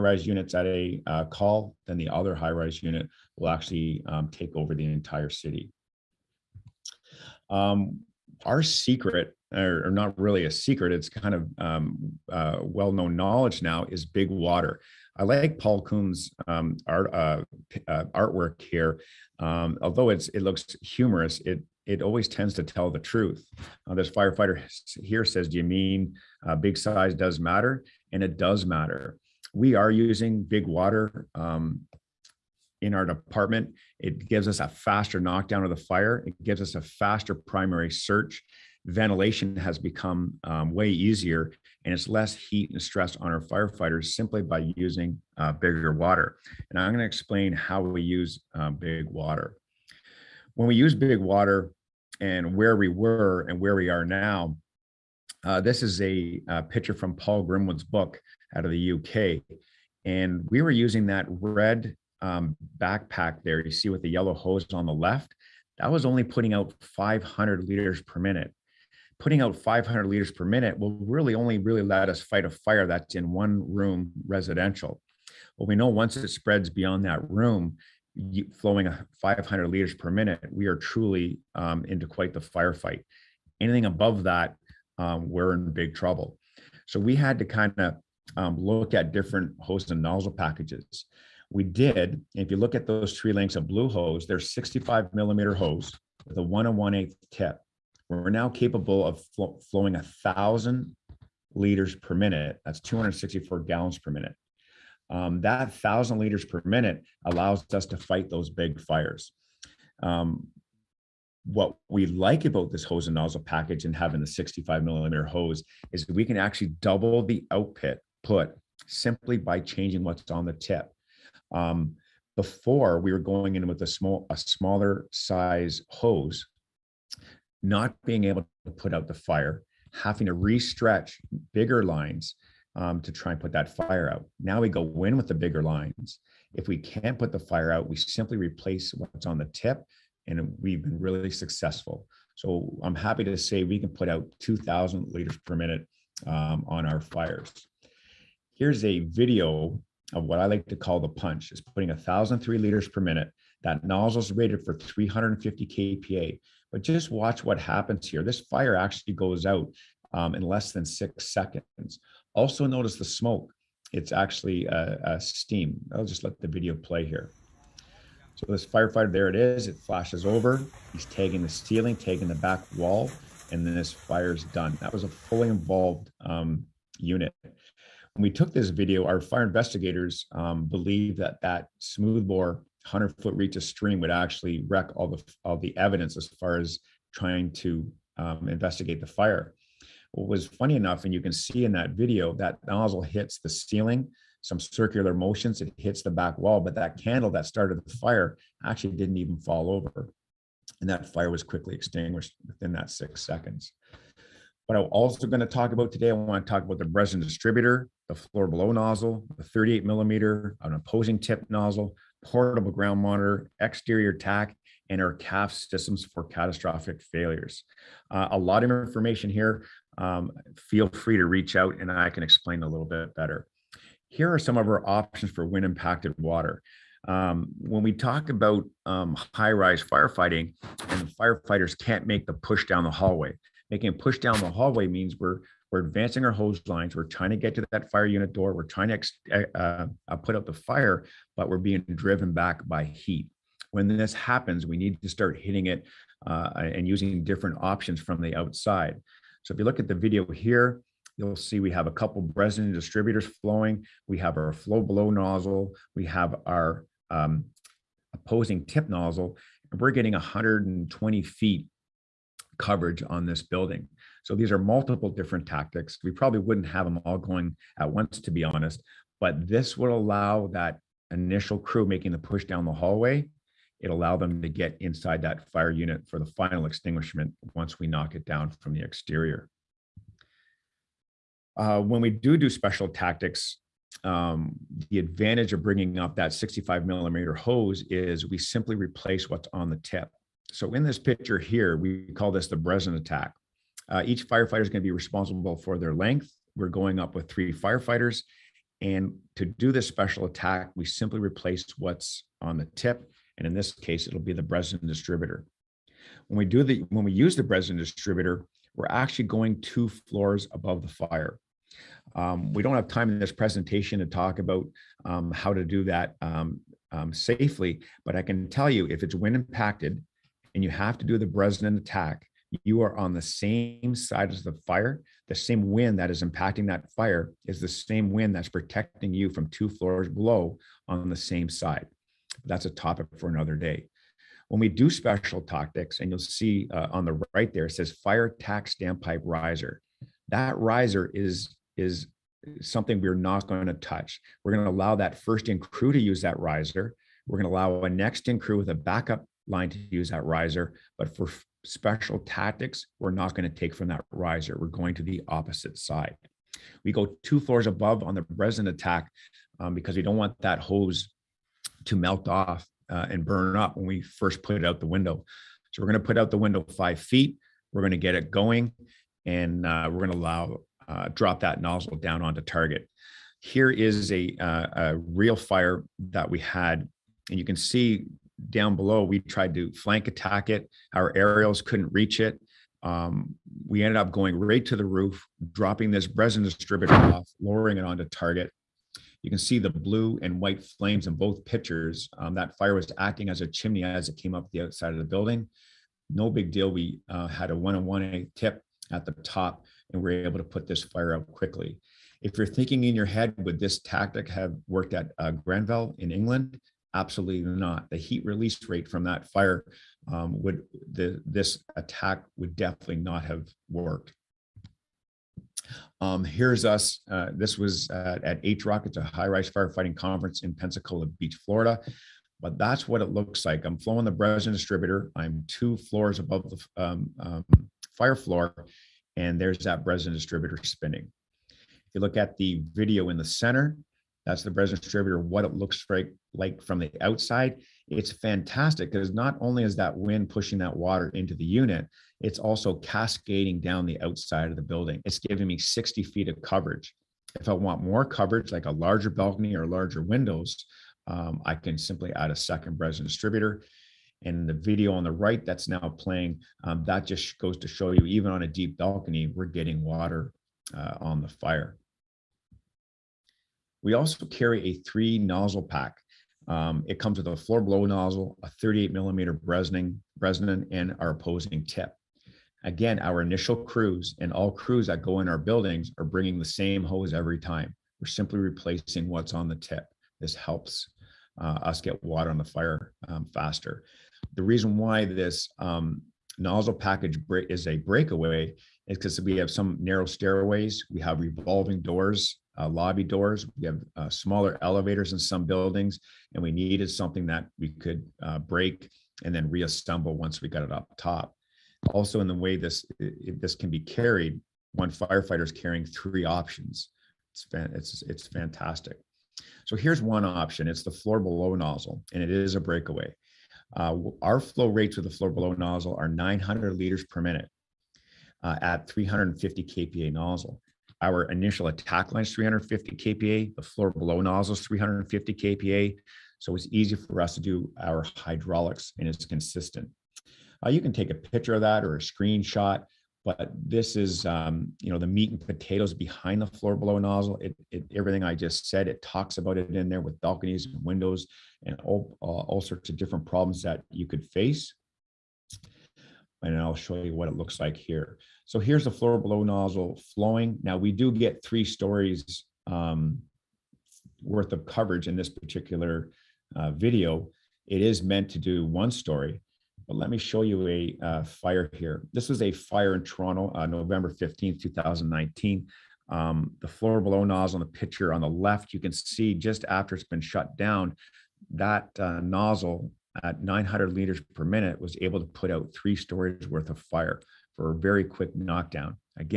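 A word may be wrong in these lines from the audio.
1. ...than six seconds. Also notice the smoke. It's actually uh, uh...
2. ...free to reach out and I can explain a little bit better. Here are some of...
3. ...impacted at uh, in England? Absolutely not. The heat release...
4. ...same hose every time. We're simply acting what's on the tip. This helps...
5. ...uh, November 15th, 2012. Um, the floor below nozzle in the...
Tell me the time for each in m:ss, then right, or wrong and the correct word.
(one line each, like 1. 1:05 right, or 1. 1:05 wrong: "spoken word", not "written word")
1. 2:40 right
2. 3:40 right
3. 6:44 wrong: "worked", not "impacted"
4. 7:56 wrong: "replacing", not "acting"
5. 9:23 wrong: "2019", not "2012".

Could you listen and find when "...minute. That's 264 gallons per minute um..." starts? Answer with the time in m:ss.
1:42.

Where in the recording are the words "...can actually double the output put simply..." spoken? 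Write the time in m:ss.
1:56.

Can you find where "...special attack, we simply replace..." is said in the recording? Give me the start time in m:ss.
4:59.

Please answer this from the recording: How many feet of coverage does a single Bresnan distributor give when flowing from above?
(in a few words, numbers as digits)
60 feet.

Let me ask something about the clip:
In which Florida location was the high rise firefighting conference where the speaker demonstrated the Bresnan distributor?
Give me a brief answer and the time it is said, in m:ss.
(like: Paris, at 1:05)
Pensacola Beach, at 7:00.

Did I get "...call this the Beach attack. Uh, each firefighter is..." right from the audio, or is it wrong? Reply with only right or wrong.
wrong.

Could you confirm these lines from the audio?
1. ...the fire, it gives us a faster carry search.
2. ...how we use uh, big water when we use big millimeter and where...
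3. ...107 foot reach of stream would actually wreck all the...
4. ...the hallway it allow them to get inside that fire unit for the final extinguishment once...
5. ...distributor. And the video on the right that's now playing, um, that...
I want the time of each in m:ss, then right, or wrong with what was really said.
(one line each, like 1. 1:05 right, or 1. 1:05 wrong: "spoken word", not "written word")
1. 0:35 wrong: "primary", not "carry"
2. 0:47 wrong: "water", not "millimeter"
3. 3:02 wrong: "100", not "107"
4. 4:32 right
5. 7:33 right.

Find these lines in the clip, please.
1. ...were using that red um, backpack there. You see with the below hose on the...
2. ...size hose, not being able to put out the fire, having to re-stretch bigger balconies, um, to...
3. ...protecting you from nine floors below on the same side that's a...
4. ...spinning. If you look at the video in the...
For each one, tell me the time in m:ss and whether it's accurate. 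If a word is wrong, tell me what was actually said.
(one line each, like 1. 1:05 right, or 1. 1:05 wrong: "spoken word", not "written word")
1. 1:00 wrong: "yellow", not "below"
2. 2:05 wrong: "lines", not "balconies"
3. 5:28 wrong: "two", not "nine"
4. 7:10 right.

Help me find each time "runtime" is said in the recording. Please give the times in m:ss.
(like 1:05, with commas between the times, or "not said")
not said.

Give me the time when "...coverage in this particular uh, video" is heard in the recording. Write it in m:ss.
9:14.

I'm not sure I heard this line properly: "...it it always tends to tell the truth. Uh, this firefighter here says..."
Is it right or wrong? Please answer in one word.
right.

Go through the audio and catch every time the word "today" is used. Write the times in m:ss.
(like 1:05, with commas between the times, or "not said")
3:25.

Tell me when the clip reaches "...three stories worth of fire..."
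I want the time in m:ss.
9:35.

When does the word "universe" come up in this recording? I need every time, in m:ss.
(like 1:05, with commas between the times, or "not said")
not said.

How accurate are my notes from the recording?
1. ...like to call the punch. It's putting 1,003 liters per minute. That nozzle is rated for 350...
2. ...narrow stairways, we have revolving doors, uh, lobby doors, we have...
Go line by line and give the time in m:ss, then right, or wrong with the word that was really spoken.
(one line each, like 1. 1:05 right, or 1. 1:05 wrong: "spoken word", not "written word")
1. 2:30 right
2. 8:09 right.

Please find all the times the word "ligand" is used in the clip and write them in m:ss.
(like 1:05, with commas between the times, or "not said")
not said.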